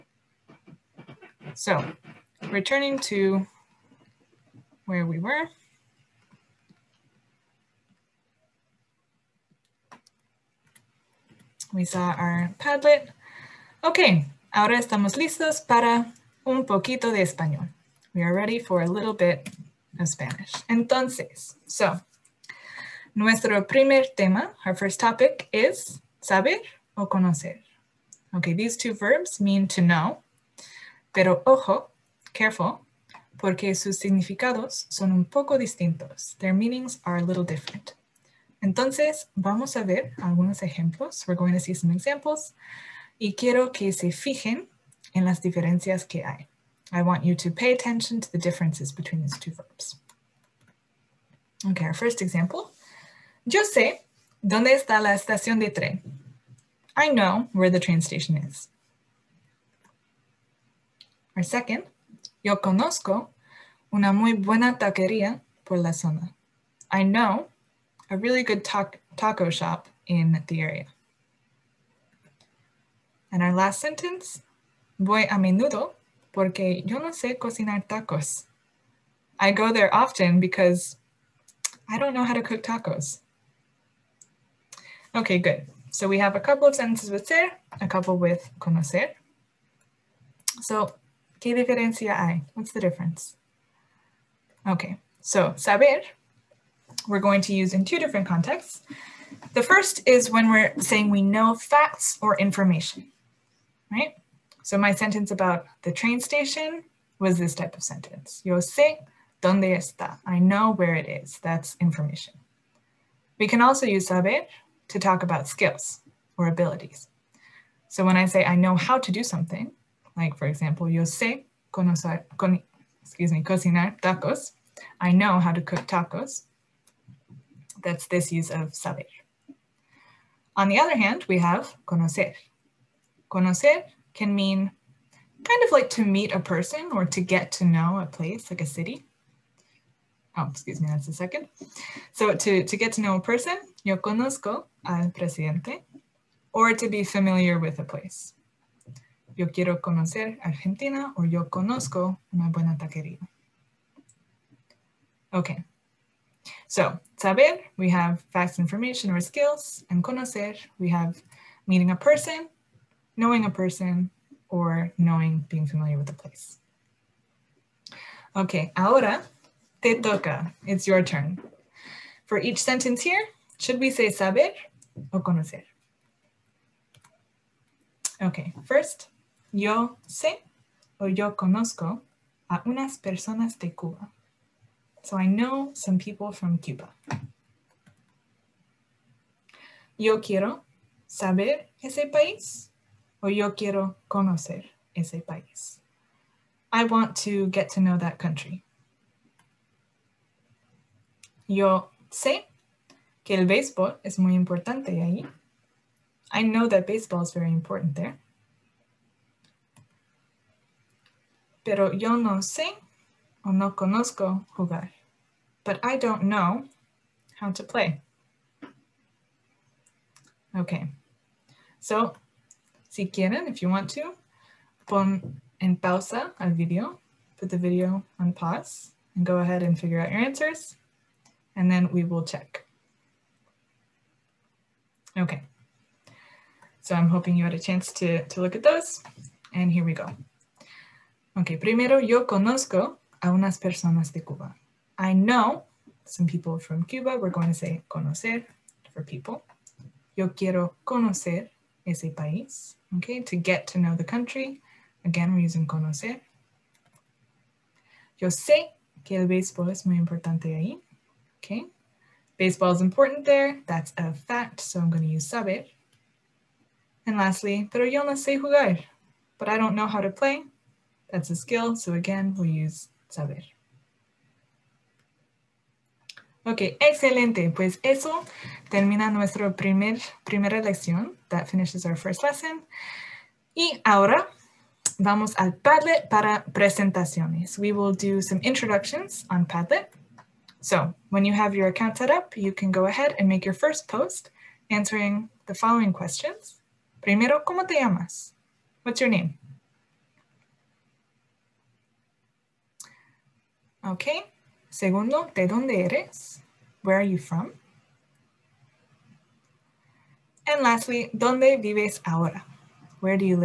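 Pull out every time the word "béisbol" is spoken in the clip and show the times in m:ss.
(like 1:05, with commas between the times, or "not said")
3:23, 4:19.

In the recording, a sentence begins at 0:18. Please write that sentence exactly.
We are ready for a little bit of Spanish.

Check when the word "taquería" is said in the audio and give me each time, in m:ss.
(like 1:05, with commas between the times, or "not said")
1:04, 2:32.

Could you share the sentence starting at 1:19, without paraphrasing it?
I go there often because I don't know how to cook tacos.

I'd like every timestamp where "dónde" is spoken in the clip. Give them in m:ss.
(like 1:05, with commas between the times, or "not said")
0:54, 1:49, 5:05, 5:11.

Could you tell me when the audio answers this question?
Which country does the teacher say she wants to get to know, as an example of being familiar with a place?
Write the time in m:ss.
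2:30.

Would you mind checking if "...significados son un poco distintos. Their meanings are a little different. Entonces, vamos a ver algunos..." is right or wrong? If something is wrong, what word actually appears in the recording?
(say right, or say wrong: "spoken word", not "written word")
right.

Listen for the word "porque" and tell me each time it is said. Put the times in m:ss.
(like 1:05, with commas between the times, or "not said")
0:33, 1:16.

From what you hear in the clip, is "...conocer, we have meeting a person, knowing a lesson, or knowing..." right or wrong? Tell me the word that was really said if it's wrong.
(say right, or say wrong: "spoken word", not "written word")
wrong: "person", not "lesson".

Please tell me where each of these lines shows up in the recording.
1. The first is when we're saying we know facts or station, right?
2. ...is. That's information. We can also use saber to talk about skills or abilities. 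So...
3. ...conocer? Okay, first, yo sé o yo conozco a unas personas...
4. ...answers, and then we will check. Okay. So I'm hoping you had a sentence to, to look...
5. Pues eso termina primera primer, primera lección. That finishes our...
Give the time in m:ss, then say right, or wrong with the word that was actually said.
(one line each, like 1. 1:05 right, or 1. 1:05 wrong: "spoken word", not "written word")
1. 1:39 wrong: "information", not "station"
2. 1:51 right
3. 2:55 right
4. 3:50 wrong: "chance", not "sentence"
5. 4:37 wrong: "nuestra", not "primera".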